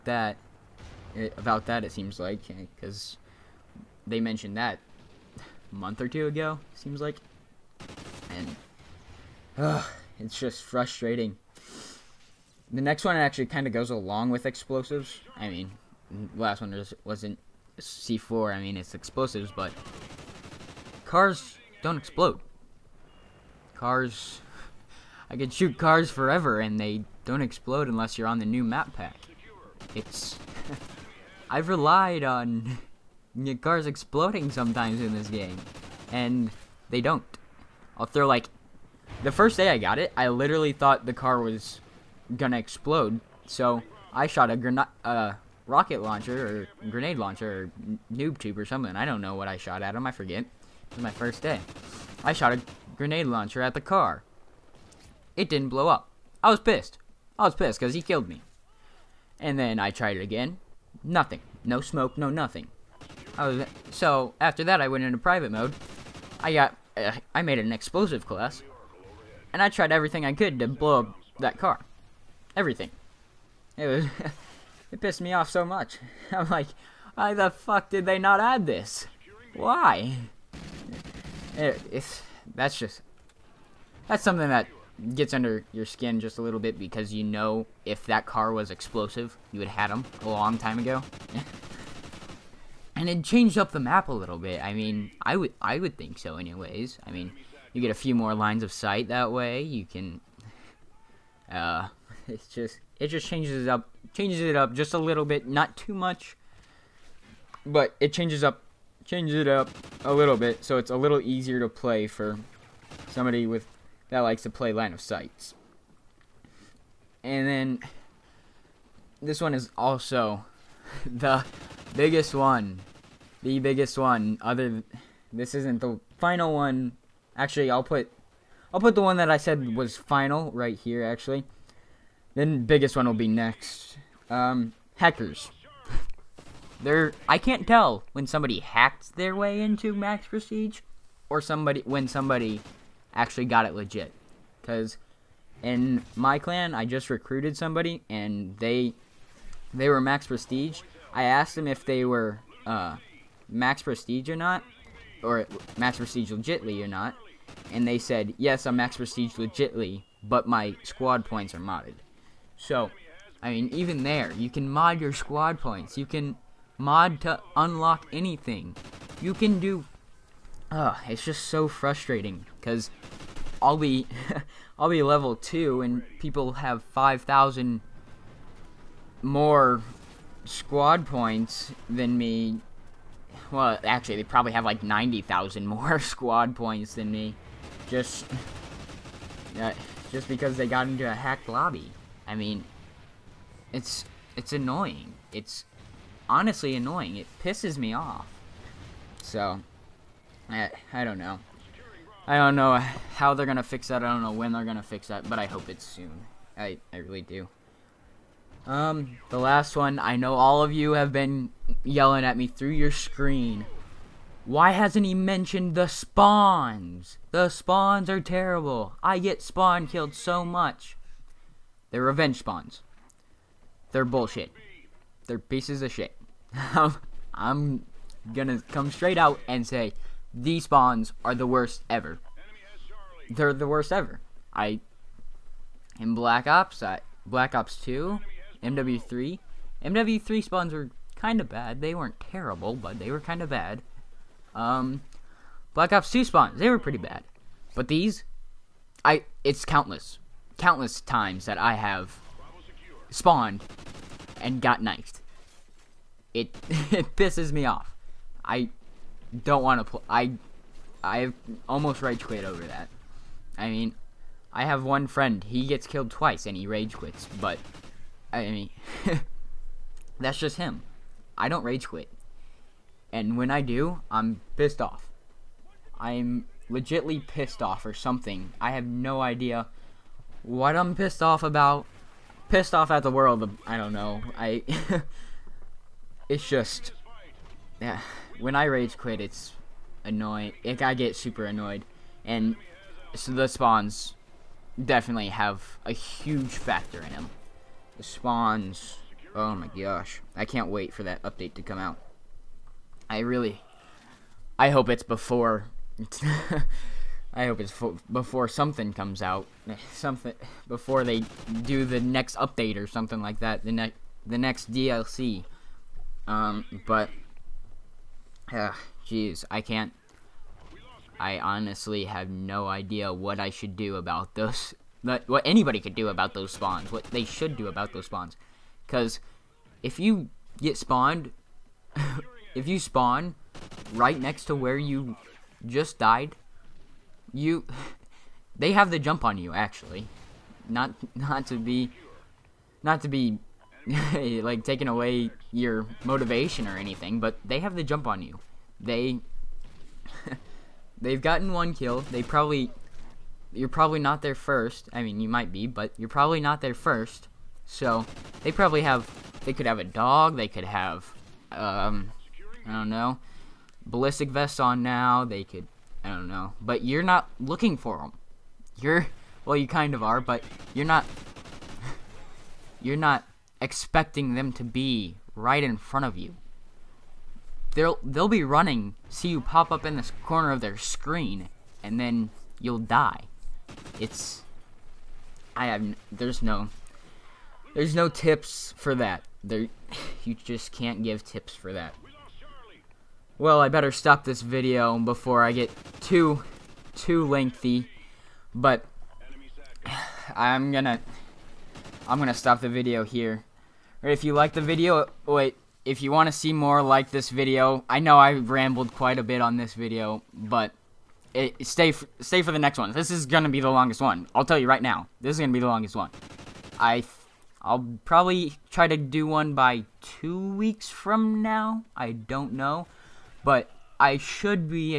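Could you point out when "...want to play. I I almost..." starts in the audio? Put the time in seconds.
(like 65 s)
259 s.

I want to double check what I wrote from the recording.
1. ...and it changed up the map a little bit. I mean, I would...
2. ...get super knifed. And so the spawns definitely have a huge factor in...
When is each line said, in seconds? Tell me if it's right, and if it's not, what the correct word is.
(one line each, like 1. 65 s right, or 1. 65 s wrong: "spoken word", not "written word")
1. 92 s right
2. 290 s wrong: "annoyed", not "knifed".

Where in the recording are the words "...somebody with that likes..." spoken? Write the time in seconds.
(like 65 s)
113 s.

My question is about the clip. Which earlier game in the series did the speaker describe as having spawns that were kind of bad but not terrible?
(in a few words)
MW3.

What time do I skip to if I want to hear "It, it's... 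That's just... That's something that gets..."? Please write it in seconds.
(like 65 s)
81 s.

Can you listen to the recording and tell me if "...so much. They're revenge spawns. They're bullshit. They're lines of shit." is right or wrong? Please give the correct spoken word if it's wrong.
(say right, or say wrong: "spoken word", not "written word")
wrong: "pieces", not "lines".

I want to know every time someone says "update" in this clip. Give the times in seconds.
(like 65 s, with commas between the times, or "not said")
301 s, 312 s.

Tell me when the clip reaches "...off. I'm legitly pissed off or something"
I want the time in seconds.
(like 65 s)
274 s.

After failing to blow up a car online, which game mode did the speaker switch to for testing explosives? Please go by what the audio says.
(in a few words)
Private mode.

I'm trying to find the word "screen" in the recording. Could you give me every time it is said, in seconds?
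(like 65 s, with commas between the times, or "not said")
212 s, 380 s.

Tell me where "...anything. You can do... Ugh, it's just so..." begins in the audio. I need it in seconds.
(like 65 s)
168 s.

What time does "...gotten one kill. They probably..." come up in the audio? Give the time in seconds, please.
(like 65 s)
351 s.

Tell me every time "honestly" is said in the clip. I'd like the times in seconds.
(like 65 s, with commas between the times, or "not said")
196 s, 321 s.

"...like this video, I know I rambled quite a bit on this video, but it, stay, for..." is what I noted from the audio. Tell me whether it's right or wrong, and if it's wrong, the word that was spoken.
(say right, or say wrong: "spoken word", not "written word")
right.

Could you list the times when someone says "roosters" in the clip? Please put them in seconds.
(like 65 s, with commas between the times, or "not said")
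not said.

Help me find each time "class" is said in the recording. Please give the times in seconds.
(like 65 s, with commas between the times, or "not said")
68 s.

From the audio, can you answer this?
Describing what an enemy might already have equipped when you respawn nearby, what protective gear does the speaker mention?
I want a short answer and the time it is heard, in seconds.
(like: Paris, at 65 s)
Ballistic vests, at 363 s.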